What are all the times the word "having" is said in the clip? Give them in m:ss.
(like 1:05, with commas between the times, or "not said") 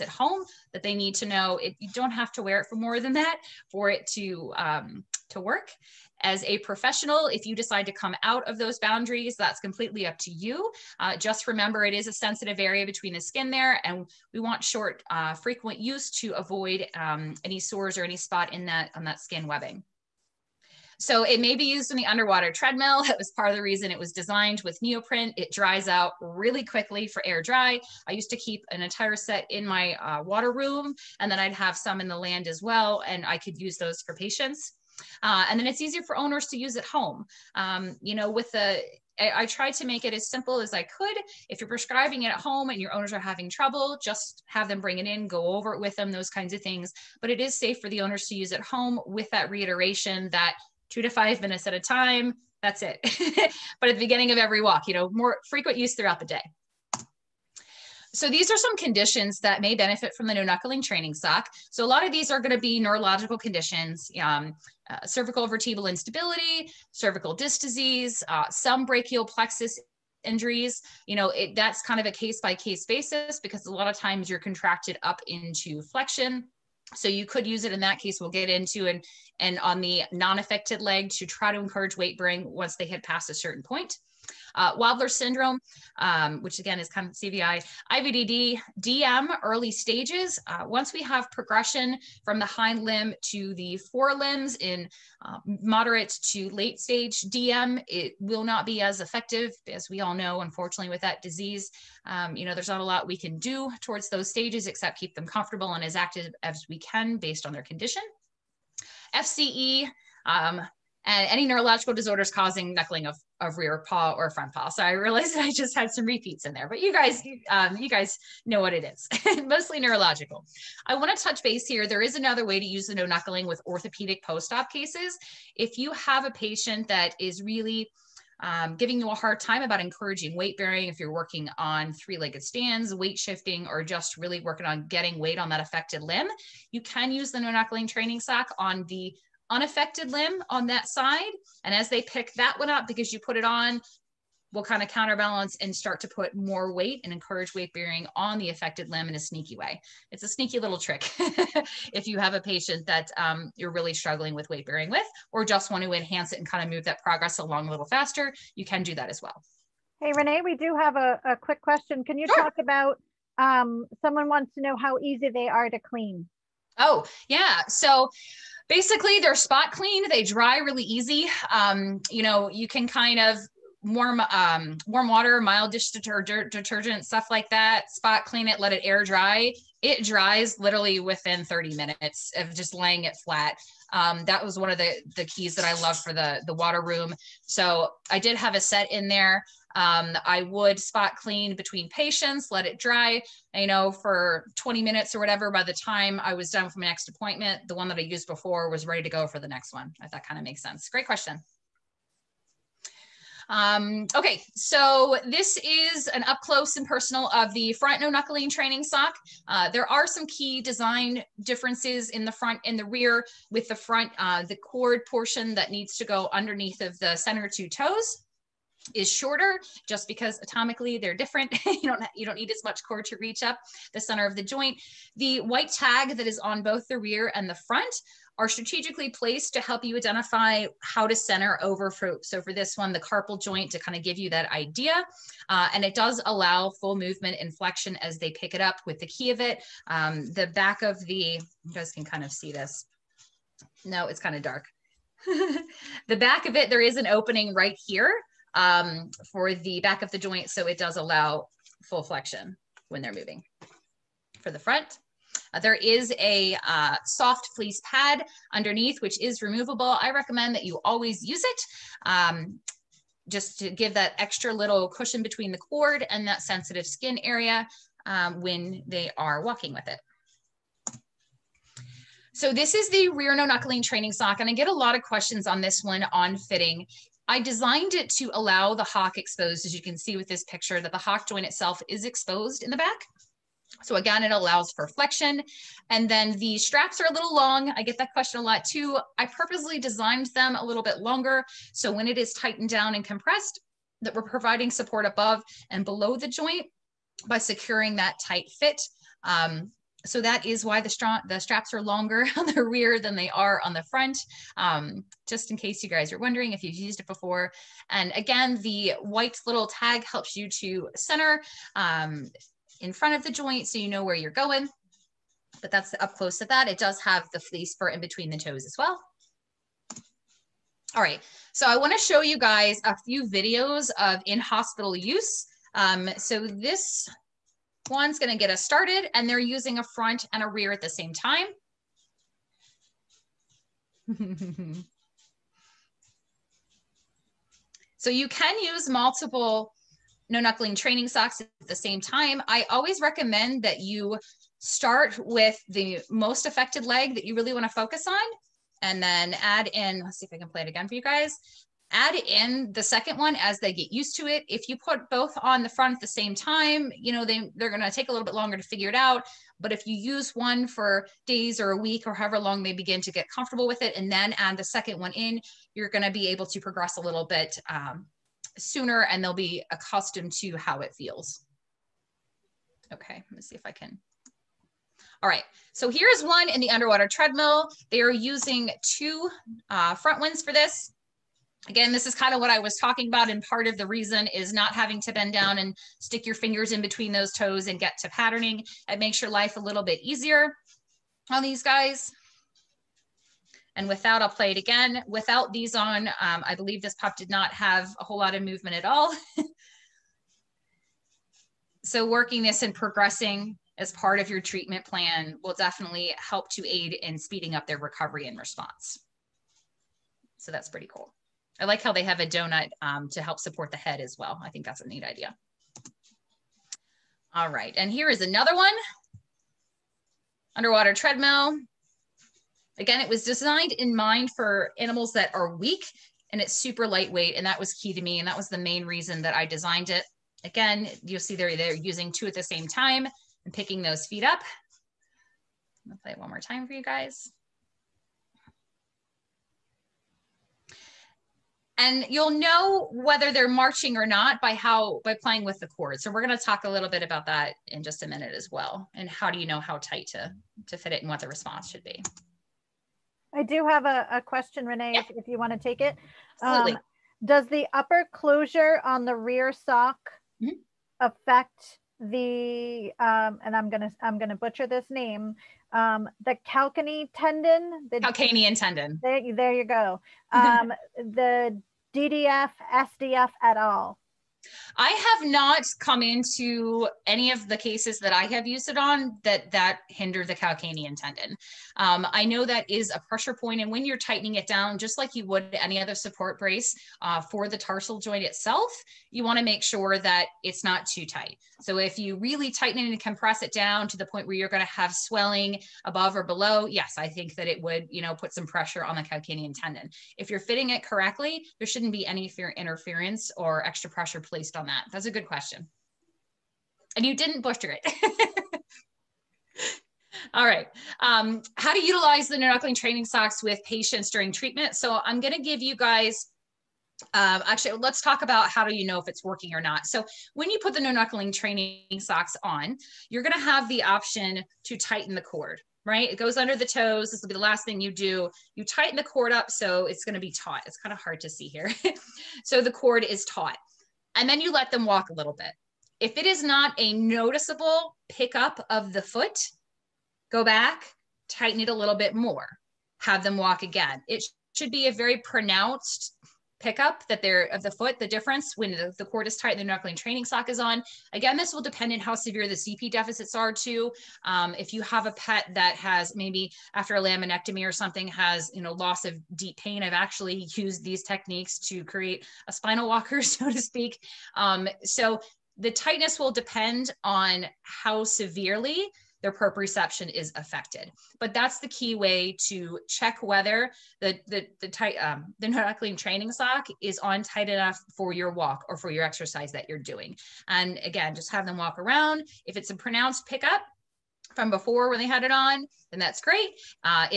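0:43, 6:24.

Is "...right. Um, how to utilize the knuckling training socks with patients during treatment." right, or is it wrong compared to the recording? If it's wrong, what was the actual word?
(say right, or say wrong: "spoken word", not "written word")
right.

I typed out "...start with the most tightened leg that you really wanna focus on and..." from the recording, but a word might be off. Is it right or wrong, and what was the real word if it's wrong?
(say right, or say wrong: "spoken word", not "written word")
wrong: "affected", not "tightened".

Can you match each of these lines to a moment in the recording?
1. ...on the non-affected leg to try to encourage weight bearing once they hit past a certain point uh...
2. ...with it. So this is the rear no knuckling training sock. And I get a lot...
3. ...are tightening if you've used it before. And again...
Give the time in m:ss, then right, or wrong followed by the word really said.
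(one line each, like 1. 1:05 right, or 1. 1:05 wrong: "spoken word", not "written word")
1. 1:19 right
2. 4:29 right
3. 5:06 wrong: "wondering", not "tightening".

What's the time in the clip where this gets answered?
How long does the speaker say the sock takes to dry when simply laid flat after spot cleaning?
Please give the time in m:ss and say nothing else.
3:01.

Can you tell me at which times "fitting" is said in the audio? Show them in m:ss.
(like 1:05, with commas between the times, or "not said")
4:36, 8:20.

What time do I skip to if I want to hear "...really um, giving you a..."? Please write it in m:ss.
2:07.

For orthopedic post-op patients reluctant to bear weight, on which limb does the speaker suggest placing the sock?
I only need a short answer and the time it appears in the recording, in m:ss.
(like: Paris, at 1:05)
The unaffected limb, at 2:19.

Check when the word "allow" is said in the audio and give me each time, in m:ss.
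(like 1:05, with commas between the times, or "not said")
3:56, 4:10, 4:38, 4:44.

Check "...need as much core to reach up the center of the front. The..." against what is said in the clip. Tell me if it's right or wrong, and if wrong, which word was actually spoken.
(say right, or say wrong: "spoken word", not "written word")
wrong: "joint", not "front".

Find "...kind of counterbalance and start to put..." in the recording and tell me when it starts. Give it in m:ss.
2:24.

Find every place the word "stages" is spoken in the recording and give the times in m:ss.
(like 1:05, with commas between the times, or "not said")
1:29, 1:36, 1:44.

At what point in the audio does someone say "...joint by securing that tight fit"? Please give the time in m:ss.
4:56.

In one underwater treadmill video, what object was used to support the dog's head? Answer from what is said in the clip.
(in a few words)
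A donut.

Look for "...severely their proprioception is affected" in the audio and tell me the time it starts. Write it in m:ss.
9:28.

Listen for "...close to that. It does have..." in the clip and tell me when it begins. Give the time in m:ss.
5:16.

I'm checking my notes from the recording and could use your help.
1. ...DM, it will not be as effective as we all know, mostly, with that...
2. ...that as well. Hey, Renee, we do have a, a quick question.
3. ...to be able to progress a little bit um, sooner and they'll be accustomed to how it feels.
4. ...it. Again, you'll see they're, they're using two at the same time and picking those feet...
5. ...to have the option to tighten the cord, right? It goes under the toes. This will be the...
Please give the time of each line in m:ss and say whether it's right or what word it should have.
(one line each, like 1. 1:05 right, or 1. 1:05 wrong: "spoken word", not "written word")
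1. 1:37 wrong: "unfortunately", not "mostly"
2. 2:38 right
3. 6:06 right
4. 7:09 right
5. 8:43 right.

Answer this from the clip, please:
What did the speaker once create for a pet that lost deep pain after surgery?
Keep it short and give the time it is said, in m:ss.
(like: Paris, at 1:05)
A spinal walker, at 9:22.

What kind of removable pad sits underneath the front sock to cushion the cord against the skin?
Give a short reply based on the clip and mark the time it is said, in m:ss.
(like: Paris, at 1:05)
Soft fleece pad, at 4:17.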